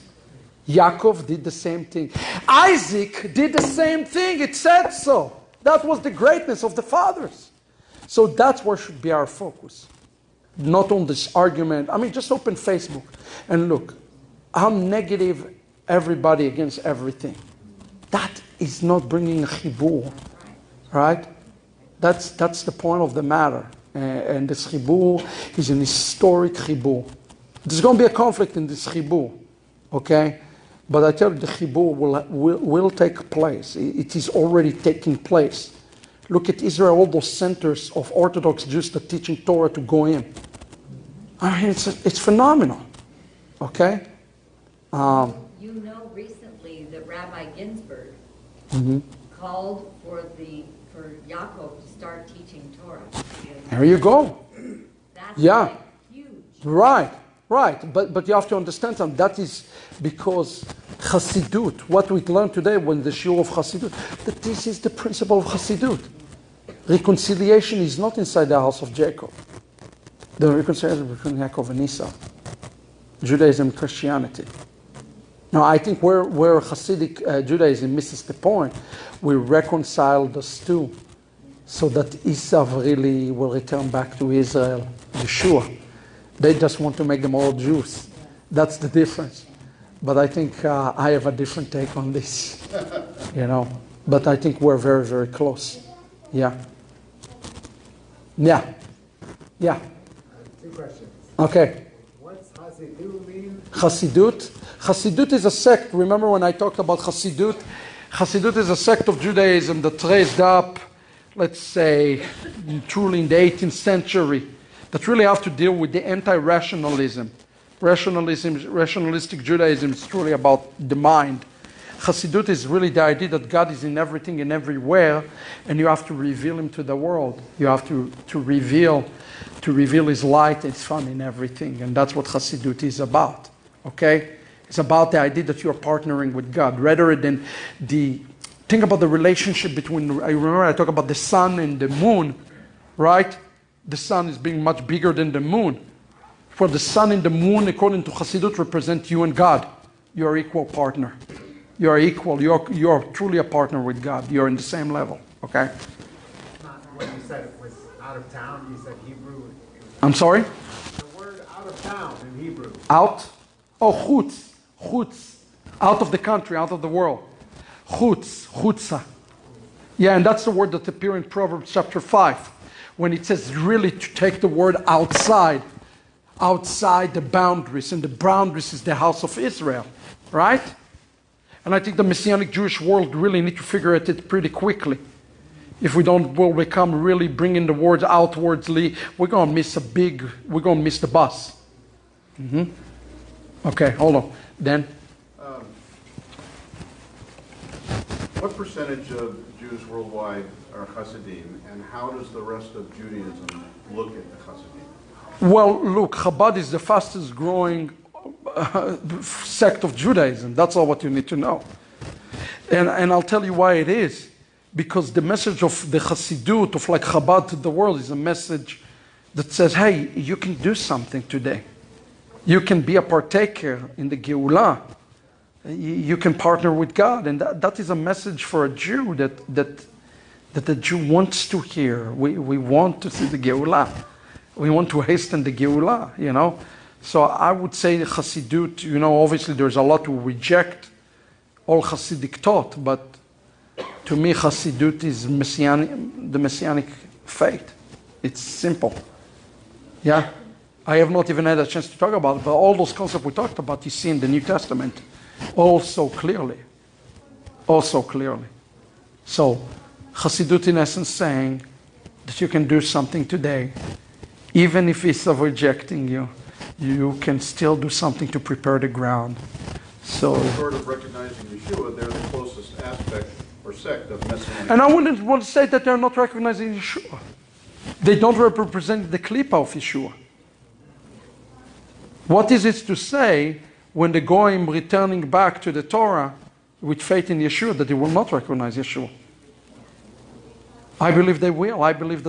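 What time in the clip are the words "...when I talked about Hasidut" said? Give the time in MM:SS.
01:46.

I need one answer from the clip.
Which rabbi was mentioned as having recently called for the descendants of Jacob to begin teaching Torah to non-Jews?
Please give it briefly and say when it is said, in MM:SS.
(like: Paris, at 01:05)
Rabbi Ginsburgh, at 00:47.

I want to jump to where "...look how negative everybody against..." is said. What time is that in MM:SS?
00:13.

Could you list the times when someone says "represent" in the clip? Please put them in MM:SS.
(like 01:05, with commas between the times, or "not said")
02:28, 04:38.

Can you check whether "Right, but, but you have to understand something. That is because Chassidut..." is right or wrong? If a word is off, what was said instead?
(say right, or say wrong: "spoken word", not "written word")
right.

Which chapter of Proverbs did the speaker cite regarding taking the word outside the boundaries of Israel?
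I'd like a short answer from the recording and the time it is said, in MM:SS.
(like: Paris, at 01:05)
Chapter 5, at 02:51.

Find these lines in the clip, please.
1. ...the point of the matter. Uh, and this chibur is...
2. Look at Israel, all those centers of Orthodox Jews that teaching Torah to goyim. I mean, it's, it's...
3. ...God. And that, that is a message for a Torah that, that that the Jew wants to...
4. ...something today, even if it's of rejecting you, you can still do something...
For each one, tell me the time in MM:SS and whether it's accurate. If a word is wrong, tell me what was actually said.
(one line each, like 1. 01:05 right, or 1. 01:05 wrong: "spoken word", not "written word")
1. 00:22 right
2. 00:36 right
3. 03:46 wrong: "Jew", not "Torah"
4. 04:22 right.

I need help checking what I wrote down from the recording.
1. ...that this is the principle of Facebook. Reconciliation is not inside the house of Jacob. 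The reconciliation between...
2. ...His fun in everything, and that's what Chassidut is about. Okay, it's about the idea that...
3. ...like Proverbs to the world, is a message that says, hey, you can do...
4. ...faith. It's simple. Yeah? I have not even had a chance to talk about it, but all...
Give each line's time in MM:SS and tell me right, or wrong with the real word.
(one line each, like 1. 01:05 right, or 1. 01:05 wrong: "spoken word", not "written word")
1. 01:04 wrong: "Chassidut", not "Facebook"
2. 02:10 right
3. 03:36 wrong: "Chabad", not "Proverbs"
4. 04:07 right.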